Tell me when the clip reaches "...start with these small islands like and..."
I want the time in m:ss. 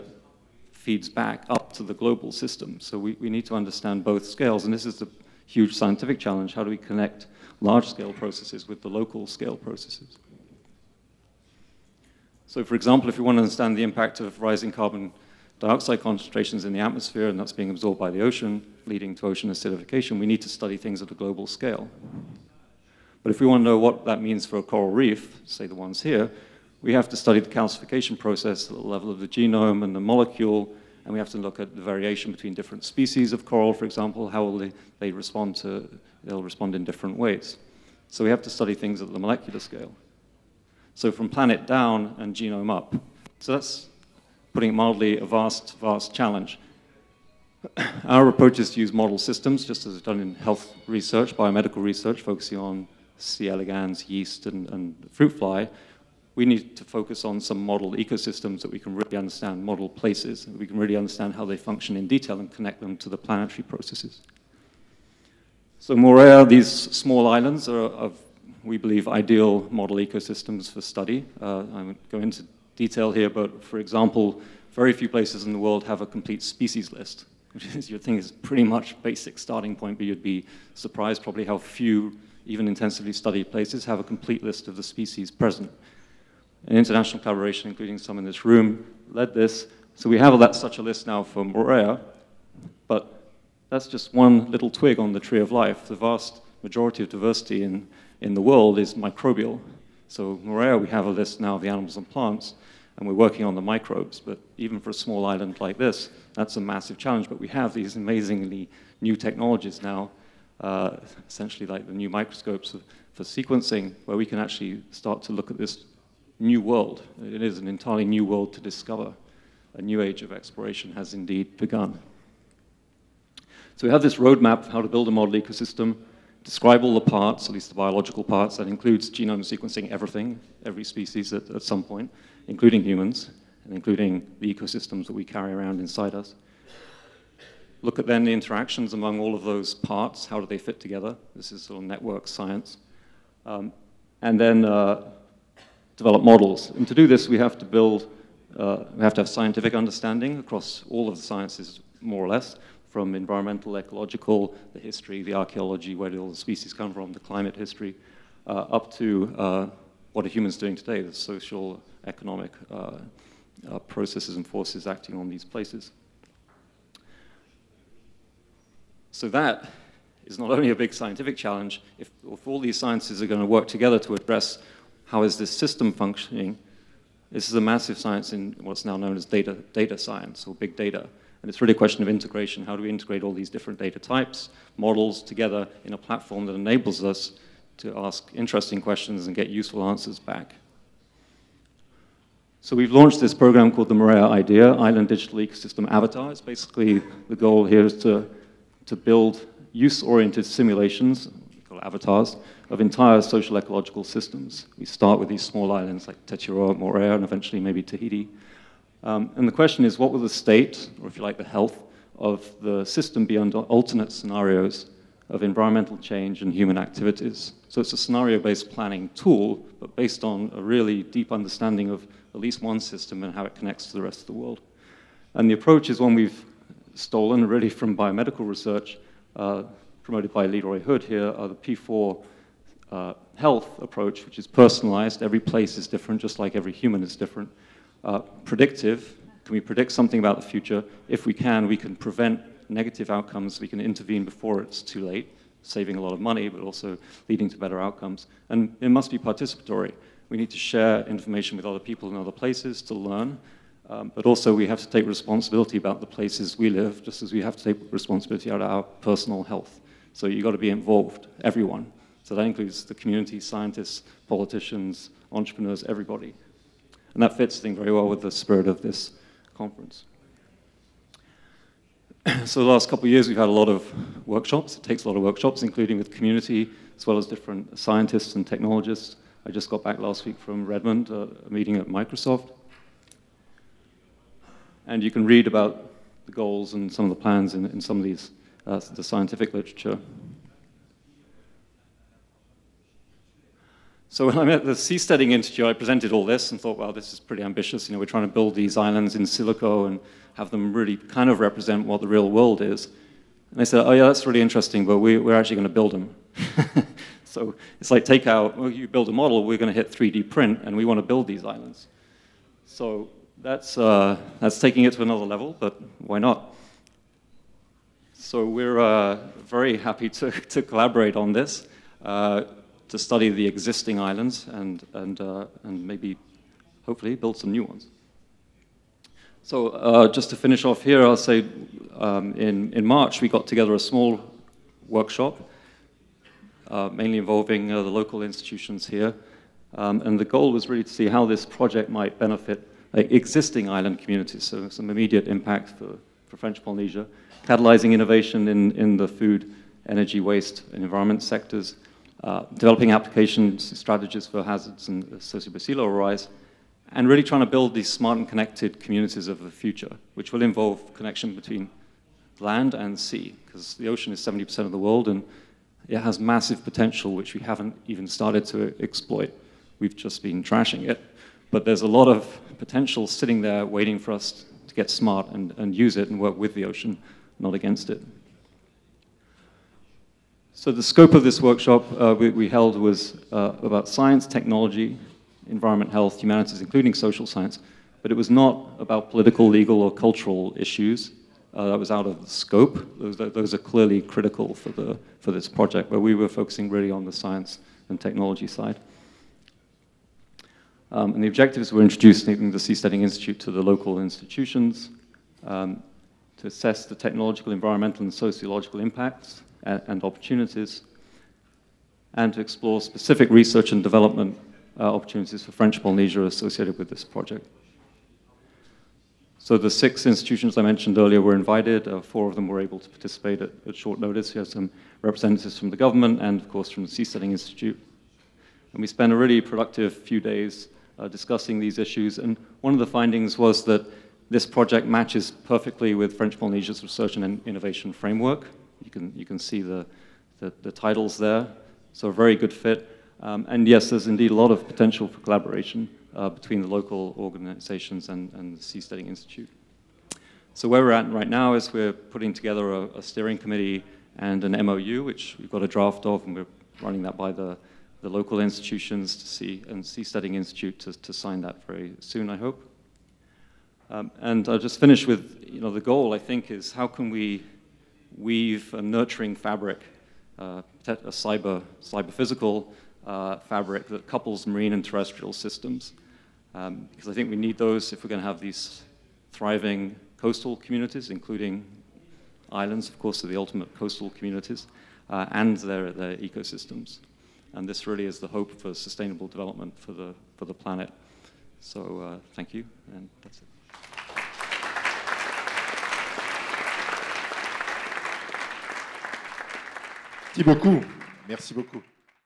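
3:24.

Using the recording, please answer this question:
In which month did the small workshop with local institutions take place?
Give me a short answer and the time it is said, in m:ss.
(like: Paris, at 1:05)
March, at 5:32.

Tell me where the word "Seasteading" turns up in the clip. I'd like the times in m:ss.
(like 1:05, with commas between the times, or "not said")
4:54, 6:42, 7:06, 7:28, 7:39.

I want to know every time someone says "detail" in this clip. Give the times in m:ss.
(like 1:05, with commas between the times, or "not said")
1:02, 1:12.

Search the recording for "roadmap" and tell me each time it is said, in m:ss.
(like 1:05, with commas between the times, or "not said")
2:04.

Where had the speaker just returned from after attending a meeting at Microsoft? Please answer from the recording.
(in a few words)
Redmond.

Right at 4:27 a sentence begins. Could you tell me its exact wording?
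And that fits very well with the spirit of this conference.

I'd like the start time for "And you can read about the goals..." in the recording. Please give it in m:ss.
4:44.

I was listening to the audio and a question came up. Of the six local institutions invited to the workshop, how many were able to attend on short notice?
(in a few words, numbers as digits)
4.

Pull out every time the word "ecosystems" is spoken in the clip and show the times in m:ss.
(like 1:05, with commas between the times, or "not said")
0:57, 1:09, 2:05, 2:14, 3:15, 8:06.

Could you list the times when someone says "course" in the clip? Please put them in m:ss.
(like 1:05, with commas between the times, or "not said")
7:06, 8:02.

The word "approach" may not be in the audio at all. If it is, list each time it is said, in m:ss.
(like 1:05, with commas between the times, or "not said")
0:48, 3:45, 3:53.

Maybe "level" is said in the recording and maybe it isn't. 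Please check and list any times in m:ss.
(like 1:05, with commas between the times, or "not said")
0:28, 5:15, 5:55.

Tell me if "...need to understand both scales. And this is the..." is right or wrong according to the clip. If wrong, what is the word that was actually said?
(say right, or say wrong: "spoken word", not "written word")
right.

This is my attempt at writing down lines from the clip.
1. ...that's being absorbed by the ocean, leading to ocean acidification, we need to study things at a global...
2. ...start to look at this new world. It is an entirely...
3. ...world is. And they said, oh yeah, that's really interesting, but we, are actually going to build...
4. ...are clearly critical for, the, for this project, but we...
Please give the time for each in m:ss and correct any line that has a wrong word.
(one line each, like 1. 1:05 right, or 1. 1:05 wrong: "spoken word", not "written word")
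1. 0:17 right
2. 1:54 right
3. 5:02 right
4. 6:33 right.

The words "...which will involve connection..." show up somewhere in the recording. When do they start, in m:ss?
6:00.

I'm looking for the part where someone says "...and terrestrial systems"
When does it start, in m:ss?
7:54.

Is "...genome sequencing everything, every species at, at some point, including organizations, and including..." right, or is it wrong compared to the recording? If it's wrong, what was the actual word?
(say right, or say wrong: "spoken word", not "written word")
wrong: "humans", not "organizations".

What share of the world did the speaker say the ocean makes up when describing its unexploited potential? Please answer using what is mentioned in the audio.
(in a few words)
70%.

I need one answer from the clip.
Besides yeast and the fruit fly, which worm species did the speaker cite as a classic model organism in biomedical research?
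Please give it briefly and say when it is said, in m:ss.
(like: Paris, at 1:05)
C. elegans, at 0:53.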